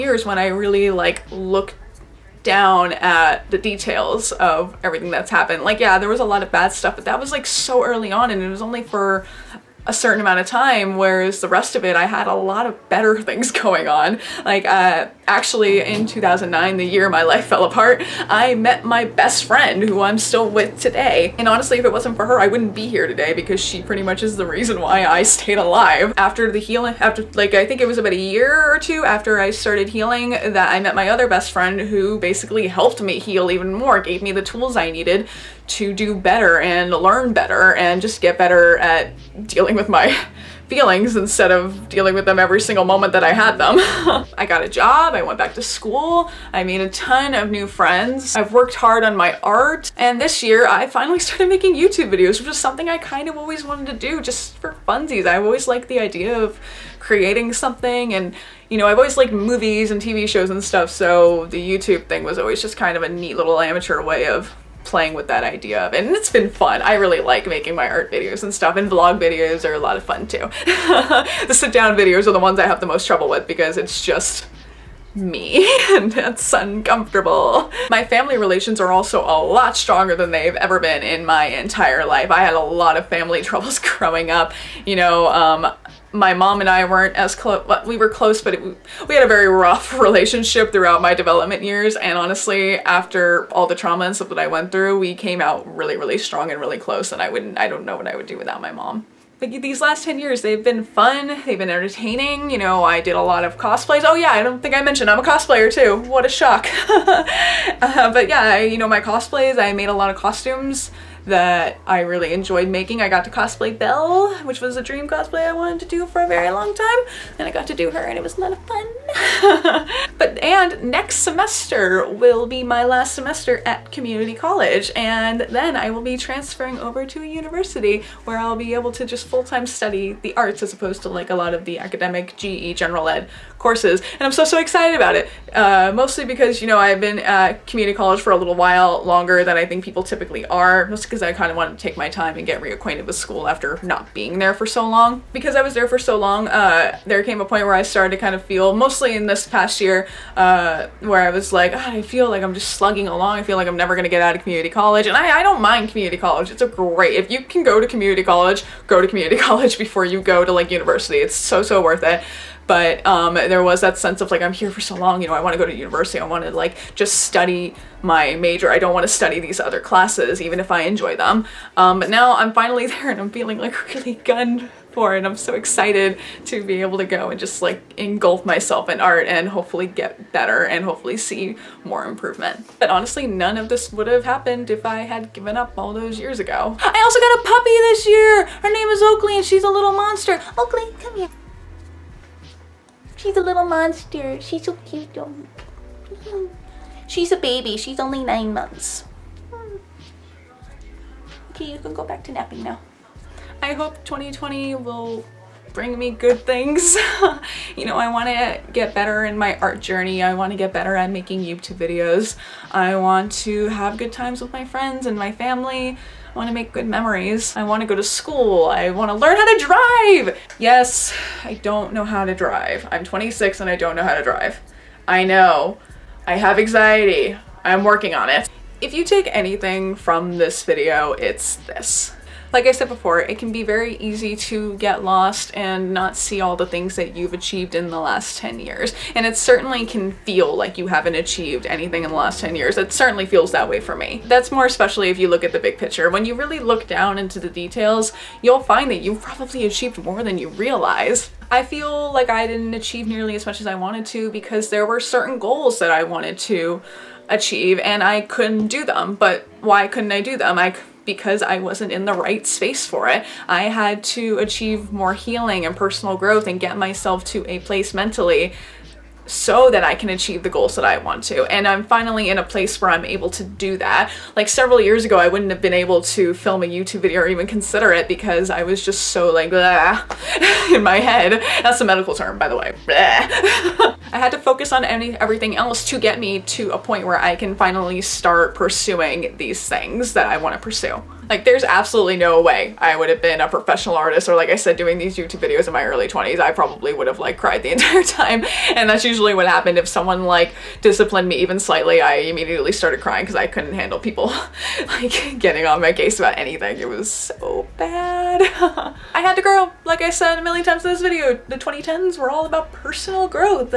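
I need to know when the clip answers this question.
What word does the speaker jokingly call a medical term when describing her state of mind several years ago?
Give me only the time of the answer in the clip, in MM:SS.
04:39.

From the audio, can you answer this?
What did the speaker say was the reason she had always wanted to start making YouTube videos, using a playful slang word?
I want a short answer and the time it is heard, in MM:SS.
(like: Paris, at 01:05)
just for funsies, at 00:54.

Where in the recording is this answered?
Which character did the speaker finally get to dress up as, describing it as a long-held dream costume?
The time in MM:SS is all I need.
01:53.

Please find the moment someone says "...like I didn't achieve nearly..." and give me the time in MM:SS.
04:12.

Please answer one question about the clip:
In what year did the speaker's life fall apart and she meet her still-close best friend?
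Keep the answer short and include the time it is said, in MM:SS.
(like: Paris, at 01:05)
2009, at 00:16.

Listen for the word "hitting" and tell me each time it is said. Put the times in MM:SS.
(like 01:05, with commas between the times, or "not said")
not said.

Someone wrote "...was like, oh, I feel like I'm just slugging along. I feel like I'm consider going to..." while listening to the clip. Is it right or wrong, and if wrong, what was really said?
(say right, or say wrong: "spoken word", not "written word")
wrong: "never", not "consider".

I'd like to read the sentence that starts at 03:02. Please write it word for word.
But honestly, none of this would have happened if I had given up all those years ago.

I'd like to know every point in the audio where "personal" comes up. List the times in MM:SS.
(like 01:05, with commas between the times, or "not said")
04:25, 05:12.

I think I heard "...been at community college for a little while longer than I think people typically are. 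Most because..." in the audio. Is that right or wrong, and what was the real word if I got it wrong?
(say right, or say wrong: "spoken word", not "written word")
right.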